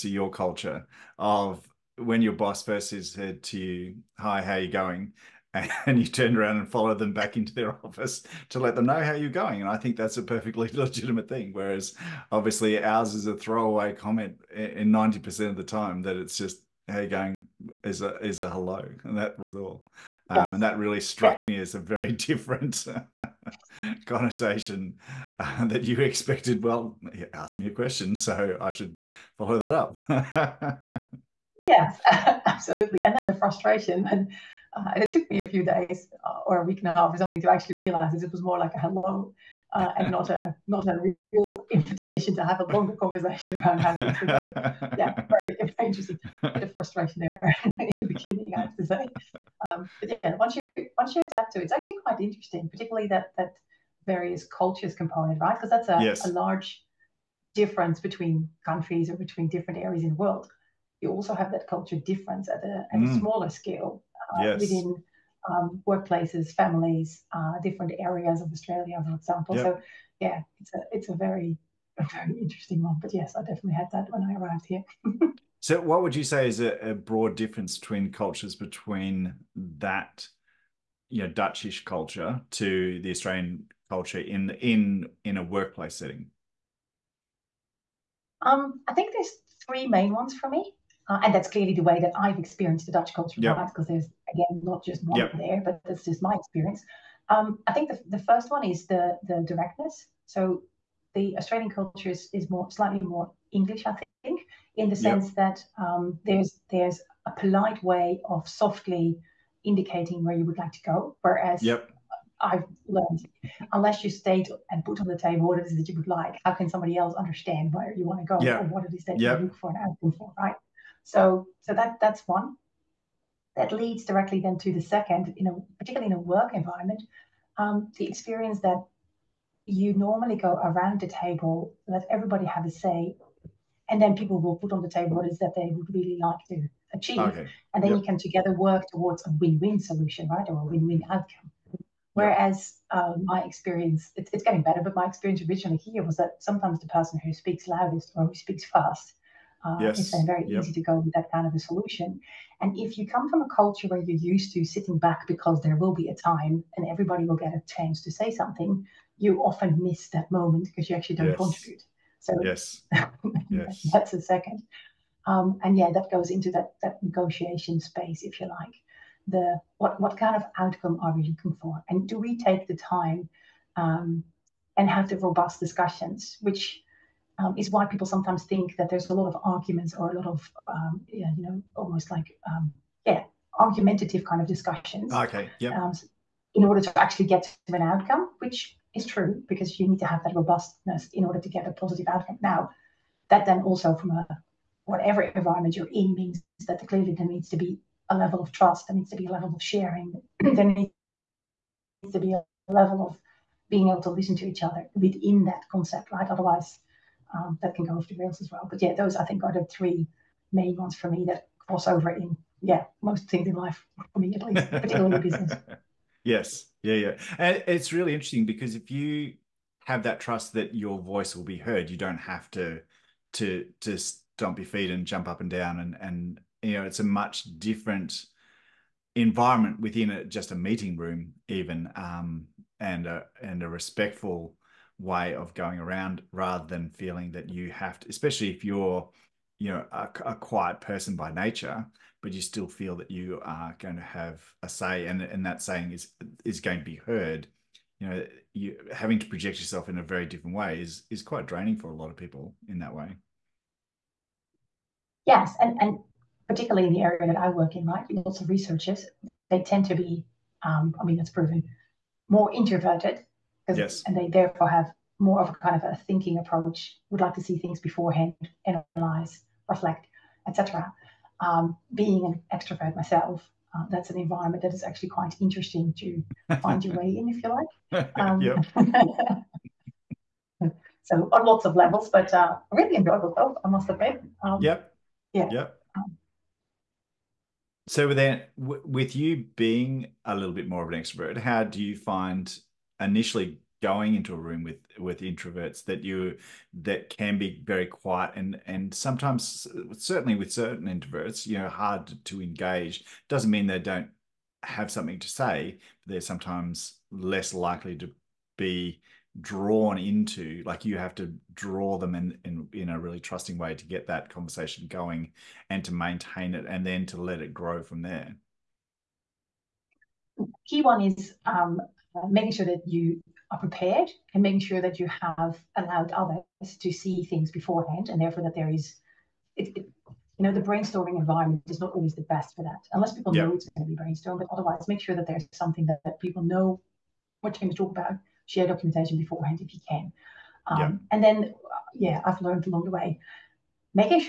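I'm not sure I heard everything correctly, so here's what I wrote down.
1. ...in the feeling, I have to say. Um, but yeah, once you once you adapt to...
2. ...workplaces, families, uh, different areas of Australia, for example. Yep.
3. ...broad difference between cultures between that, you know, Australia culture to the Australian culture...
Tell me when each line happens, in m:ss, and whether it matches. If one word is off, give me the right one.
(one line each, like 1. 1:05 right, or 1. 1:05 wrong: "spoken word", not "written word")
1. 0:47 wrong: "beginning", not "feeling"
2. 1:05 right
3. 1:16 wrong: "Dutchish", not "Australia".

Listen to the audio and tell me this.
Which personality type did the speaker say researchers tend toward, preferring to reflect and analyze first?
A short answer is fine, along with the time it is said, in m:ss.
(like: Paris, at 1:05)
introverted, at 4:22.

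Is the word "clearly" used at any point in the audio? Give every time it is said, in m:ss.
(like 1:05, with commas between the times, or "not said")
1:31, 3:16.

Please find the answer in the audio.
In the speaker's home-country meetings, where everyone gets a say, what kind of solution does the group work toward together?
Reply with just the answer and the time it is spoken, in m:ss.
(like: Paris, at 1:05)
win-win solution, at 2:19.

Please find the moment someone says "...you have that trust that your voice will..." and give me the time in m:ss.
3:38.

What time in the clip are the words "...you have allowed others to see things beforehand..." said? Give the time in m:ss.
5:24.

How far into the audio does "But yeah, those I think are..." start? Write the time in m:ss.
3:28.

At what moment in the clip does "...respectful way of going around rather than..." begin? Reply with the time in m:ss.
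3:53.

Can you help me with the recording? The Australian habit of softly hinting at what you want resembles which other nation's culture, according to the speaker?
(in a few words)
English.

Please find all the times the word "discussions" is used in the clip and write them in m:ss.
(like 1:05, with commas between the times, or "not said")
2:55, 3:04.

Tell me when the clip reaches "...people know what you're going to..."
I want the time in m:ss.
5:36.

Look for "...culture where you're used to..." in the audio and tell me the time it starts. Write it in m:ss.
2:33.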